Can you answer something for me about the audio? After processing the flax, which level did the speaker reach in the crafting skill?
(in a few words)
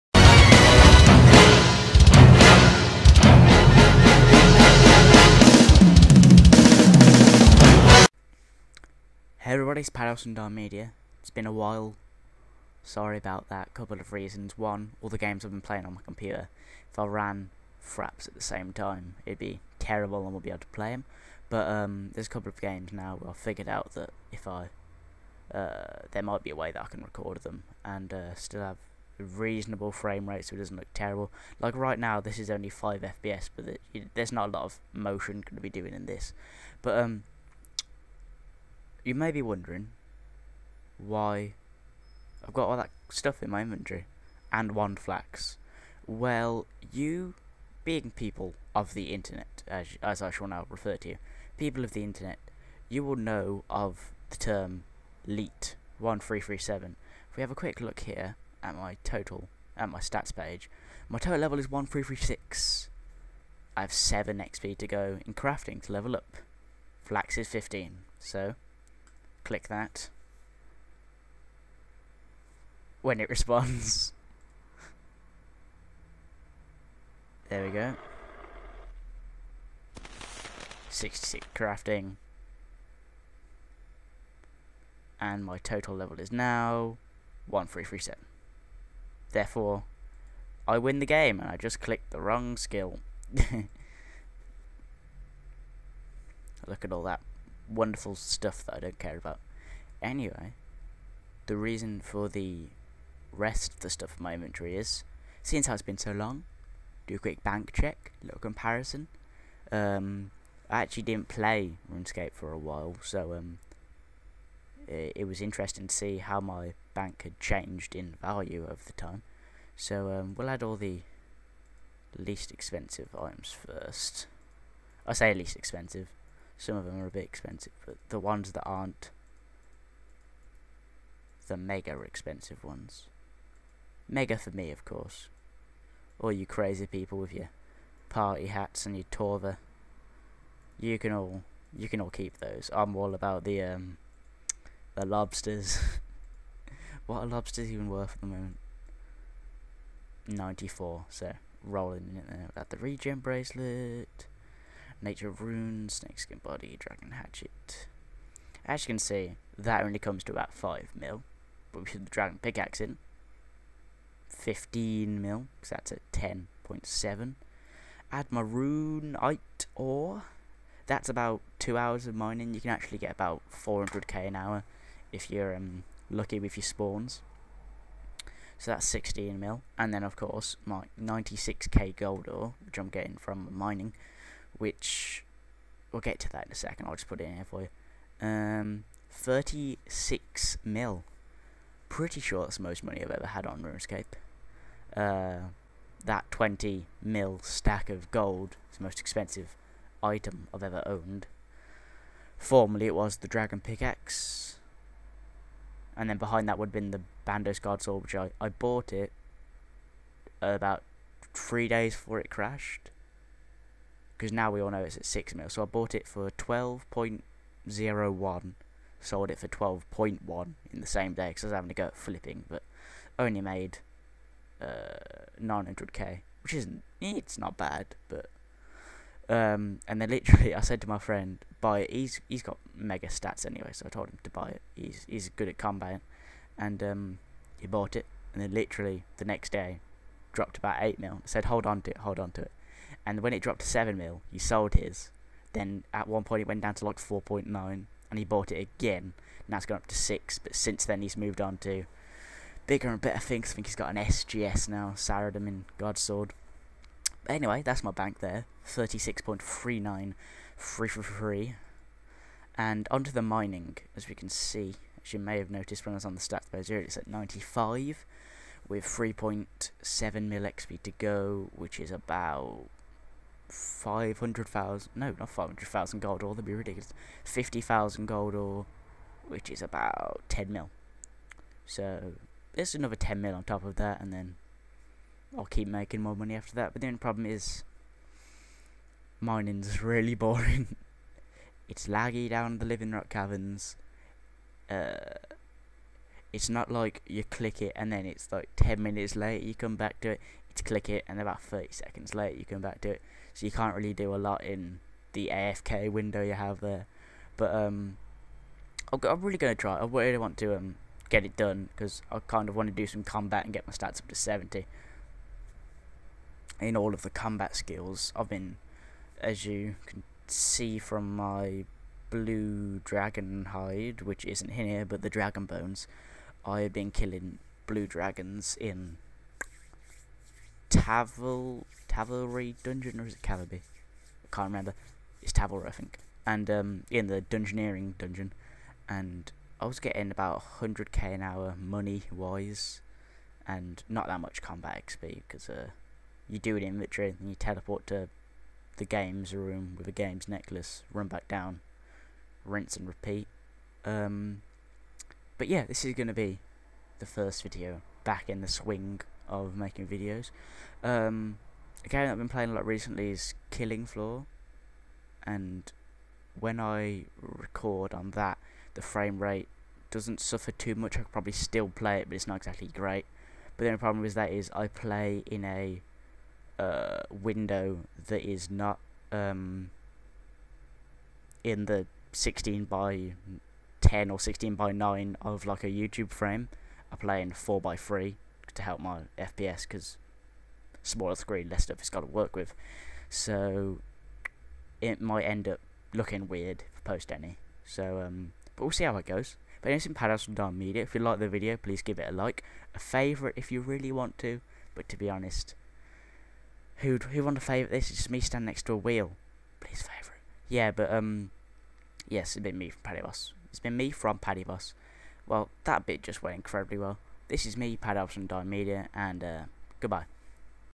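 66.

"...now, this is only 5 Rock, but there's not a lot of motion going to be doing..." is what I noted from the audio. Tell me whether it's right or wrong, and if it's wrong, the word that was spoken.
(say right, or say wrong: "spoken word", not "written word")
wrong: "FPS", not "Rock".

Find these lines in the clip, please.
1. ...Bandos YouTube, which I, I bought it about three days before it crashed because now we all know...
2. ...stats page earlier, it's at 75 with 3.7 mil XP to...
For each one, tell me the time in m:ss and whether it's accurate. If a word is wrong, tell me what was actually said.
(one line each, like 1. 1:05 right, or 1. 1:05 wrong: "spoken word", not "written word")
1. 3:27 wrong: "Godsword", not "YouTube"
2. 4:26 wrong: "95", not "75".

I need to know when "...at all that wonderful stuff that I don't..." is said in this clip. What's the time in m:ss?
1:36.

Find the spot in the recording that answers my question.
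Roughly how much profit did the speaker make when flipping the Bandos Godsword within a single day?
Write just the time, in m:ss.
3:45.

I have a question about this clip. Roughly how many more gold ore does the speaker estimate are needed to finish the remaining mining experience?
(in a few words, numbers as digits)
50,000.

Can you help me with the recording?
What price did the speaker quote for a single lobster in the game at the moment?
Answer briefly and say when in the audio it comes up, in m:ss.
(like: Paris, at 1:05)
94, at 2:30.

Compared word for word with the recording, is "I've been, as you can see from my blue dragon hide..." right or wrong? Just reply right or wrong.
right.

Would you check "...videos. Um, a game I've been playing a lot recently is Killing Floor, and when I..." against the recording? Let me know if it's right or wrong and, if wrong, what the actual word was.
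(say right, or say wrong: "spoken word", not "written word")
right.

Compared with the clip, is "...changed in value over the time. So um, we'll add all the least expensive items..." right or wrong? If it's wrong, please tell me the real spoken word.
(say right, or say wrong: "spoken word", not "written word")
right.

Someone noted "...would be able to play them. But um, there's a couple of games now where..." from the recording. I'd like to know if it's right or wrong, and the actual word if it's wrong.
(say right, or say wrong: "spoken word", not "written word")
right.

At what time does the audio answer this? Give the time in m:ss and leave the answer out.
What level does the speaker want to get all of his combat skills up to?
5:14.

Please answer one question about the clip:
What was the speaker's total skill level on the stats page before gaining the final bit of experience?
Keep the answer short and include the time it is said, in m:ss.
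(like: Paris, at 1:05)
1336, at 1:01.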